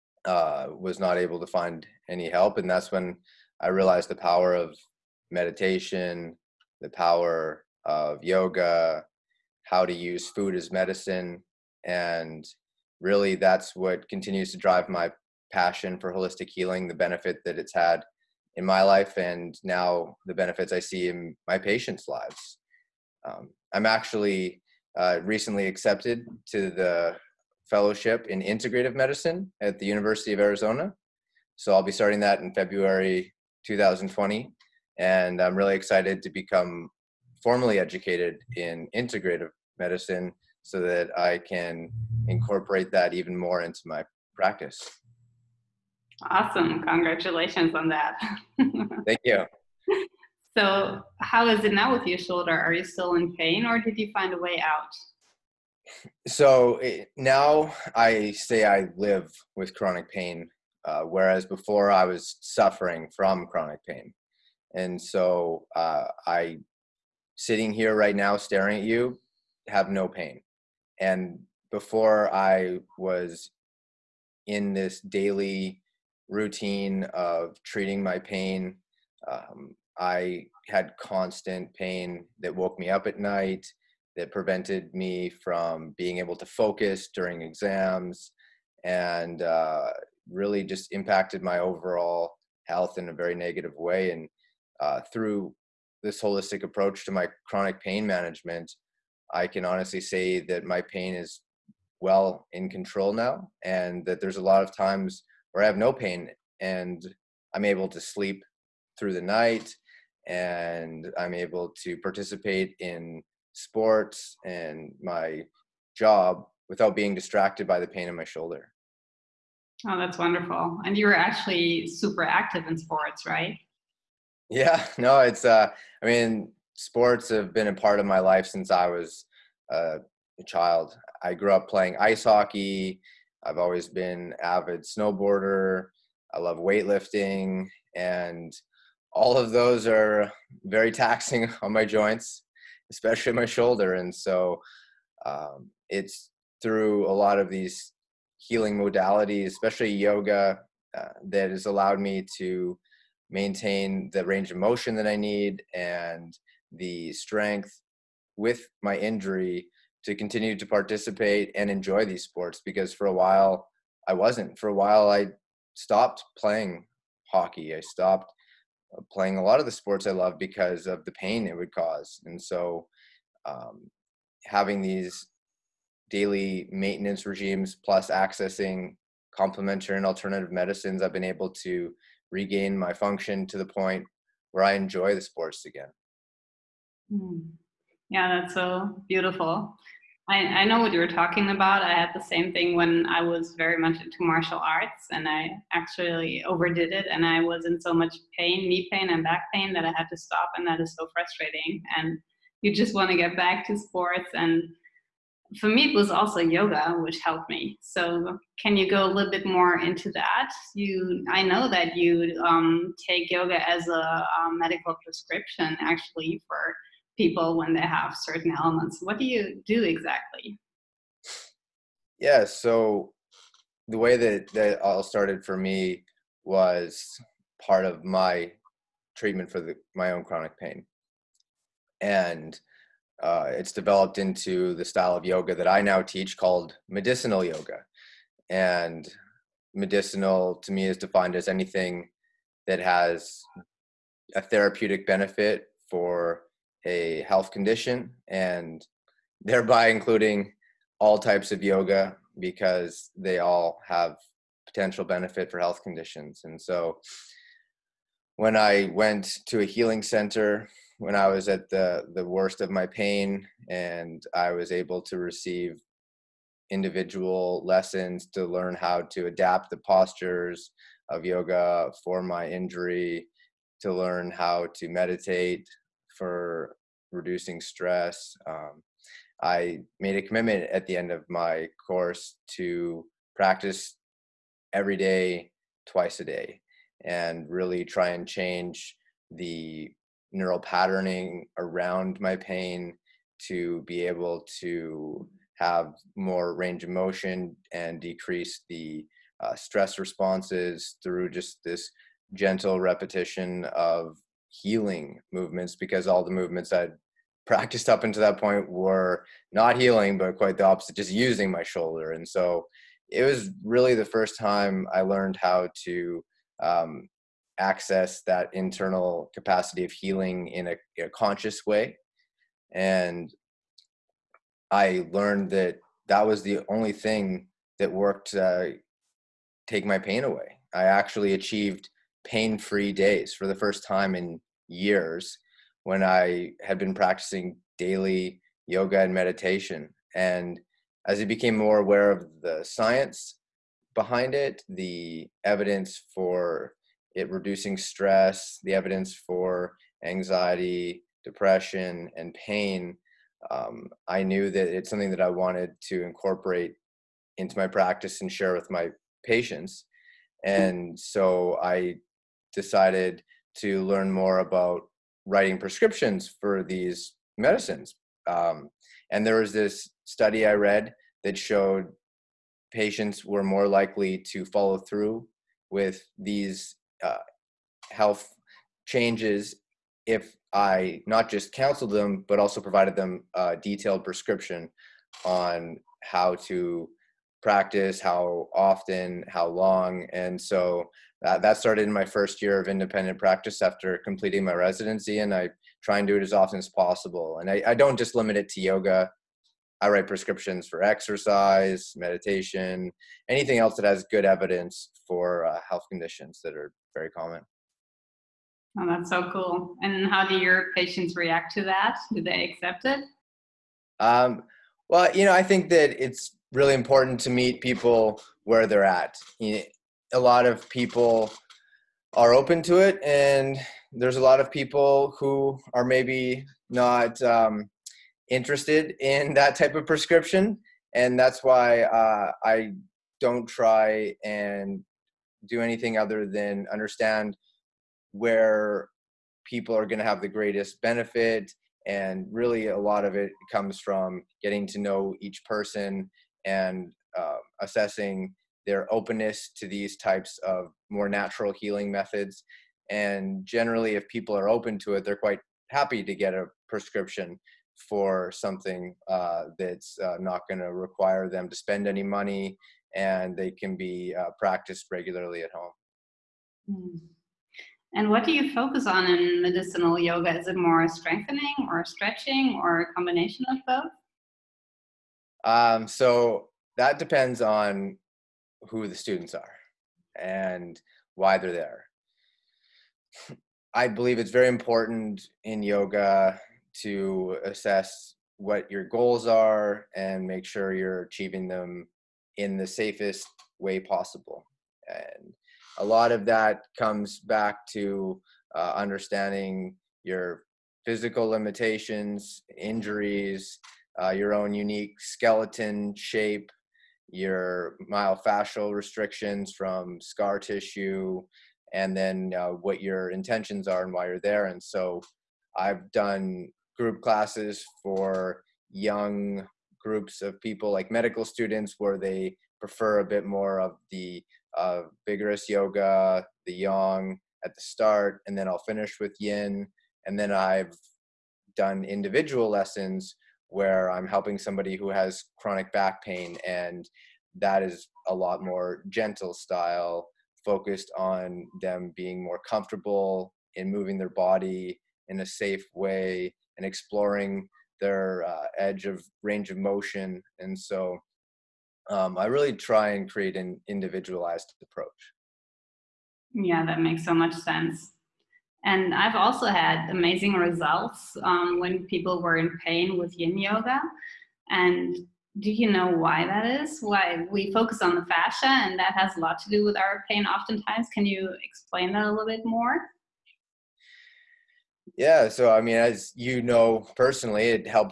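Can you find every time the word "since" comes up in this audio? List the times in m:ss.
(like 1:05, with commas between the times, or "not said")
2:08.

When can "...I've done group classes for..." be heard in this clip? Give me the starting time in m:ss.
8:35.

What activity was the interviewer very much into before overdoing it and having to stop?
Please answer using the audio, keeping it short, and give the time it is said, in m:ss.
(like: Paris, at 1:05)
Martial arts, at 3:14.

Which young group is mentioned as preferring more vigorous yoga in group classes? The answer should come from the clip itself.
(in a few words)
Medical students.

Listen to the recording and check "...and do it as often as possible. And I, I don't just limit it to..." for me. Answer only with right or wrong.
right.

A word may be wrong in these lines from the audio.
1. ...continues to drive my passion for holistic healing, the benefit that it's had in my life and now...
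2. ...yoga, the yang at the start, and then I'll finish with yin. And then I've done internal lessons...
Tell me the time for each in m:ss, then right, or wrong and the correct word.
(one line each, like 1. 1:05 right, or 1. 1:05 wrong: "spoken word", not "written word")
1. 0:14 right
2. 8:45 wrong: "individual", not "internal".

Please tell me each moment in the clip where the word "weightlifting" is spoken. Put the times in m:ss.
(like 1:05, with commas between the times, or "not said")
2:16.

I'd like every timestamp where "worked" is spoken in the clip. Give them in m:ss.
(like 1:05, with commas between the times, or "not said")
5:27.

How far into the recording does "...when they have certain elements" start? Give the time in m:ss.
3:37.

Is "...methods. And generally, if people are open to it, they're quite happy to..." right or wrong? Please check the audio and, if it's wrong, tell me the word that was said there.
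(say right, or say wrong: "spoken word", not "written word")
right.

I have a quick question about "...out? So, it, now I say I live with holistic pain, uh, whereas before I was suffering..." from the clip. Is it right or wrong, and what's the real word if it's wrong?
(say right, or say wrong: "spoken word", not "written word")
wrong: "chronic", not "holistic".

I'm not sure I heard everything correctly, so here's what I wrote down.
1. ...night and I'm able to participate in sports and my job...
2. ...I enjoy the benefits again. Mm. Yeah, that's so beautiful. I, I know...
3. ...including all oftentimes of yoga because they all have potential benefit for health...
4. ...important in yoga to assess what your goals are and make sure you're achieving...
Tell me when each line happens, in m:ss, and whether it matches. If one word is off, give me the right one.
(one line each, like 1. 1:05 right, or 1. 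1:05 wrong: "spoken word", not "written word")
1. 1:49 right
2. 3:04 wrong: "sports", not "benefits"
3. 4:09 wrong: "types", not "oftentimes"
4. 8:04 right.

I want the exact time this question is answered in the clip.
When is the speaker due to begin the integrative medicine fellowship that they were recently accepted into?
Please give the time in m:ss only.
0:32.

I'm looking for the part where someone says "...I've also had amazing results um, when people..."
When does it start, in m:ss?
9:18.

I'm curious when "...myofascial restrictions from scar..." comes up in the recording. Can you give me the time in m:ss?
8:27.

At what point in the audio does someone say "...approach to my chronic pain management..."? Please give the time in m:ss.
1:36.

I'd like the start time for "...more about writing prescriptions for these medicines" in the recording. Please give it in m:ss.
6:04.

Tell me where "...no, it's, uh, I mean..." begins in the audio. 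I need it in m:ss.
2:04.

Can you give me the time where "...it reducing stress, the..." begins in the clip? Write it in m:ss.
5:47.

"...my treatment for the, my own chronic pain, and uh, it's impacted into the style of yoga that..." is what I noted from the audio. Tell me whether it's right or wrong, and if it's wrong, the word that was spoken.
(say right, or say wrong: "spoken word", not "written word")
wrong: "developed", not "impacted".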